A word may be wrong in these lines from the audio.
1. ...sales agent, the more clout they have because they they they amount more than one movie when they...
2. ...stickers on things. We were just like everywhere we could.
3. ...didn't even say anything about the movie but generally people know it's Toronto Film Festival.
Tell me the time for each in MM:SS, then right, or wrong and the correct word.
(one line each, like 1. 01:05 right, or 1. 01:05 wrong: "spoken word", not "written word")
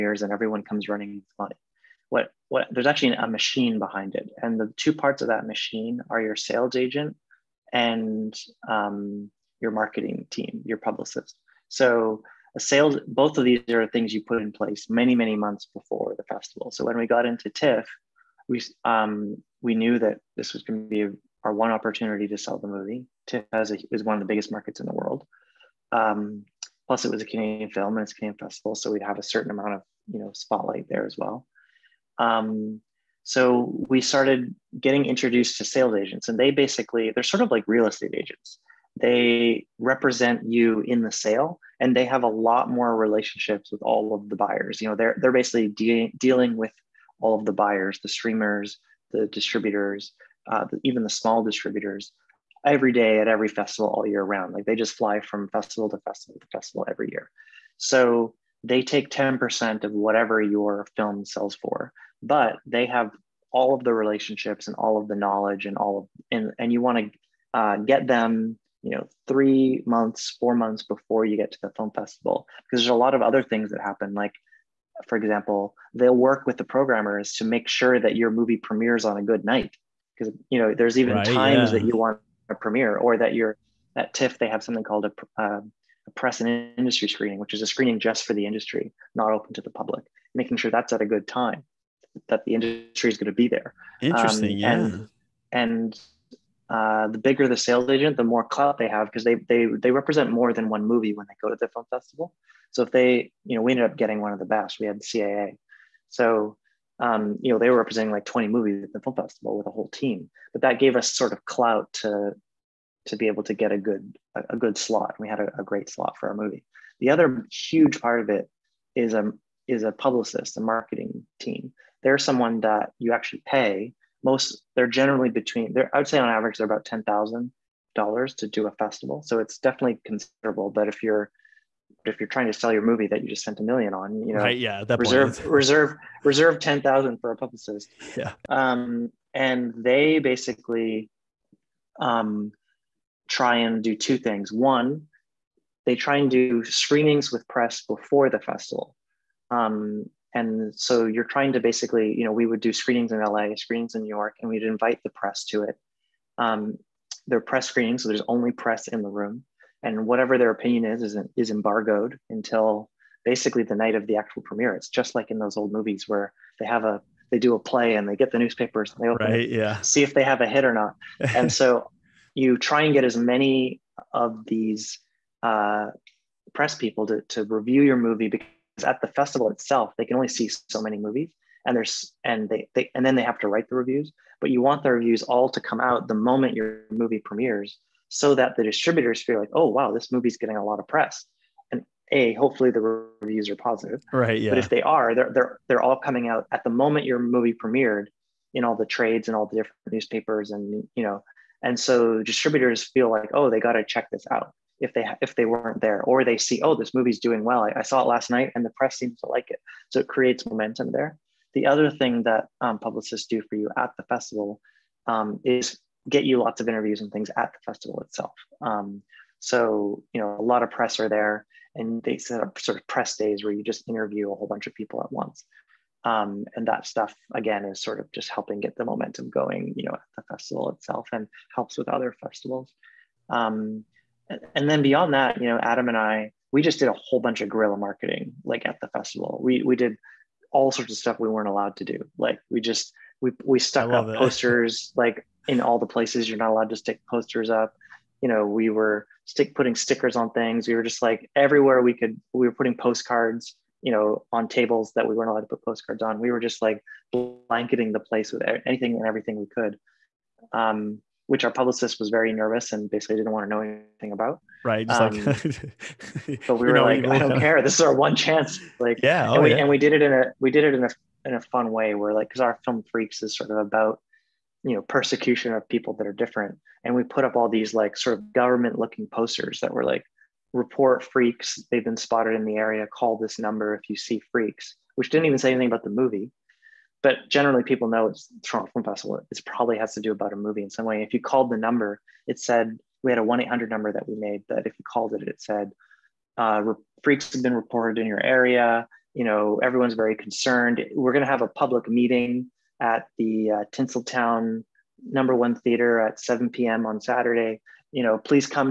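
1. 01:37 wrong: "represent", not "amount"
2. 04:09 right
3. 04:45 right.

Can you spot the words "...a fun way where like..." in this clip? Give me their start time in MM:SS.
04:31.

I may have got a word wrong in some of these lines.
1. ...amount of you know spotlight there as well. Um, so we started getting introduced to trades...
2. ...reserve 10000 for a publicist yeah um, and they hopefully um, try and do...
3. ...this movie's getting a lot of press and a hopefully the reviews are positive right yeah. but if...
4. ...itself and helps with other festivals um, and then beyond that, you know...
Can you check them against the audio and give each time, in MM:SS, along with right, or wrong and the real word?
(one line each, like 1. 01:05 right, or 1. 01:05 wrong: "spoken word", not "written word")
1. 00:29 wrong: "sales", not "trades"
2. 02:16 wrong: "basically", not "hopefully"
3. 03:09 right
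4. 03:50 right.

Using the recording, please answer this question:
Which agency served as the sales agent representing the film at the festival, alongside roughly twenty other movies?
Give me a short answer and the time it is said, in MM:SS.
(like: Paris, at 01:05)
CAA, at 01:45.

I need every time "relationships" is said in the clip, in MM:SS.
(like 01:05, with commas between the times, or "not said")
00:42, 01:03.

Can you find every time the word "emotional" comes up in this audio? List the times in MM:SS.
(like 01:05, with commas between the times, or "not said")
not said.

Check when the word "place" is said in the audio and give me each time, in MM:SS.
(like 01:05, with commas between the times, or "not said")
00:14, 04:05, 04:17.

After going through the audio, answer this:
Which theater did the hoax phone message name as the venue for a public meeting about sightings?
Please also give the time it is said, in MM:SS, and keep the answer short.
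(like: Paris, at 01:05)
Tinseltown Number One Theater, at 05:03.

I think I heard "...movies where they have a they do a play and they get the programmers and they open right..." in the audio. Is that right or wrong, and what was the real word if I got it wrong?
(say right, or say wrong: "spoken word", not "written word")
wrong: "newspapers", not "programmers".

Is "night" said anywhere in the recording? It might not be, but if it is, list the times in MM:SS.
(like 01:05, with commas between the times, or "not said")
01:19, 02:43, 03:28.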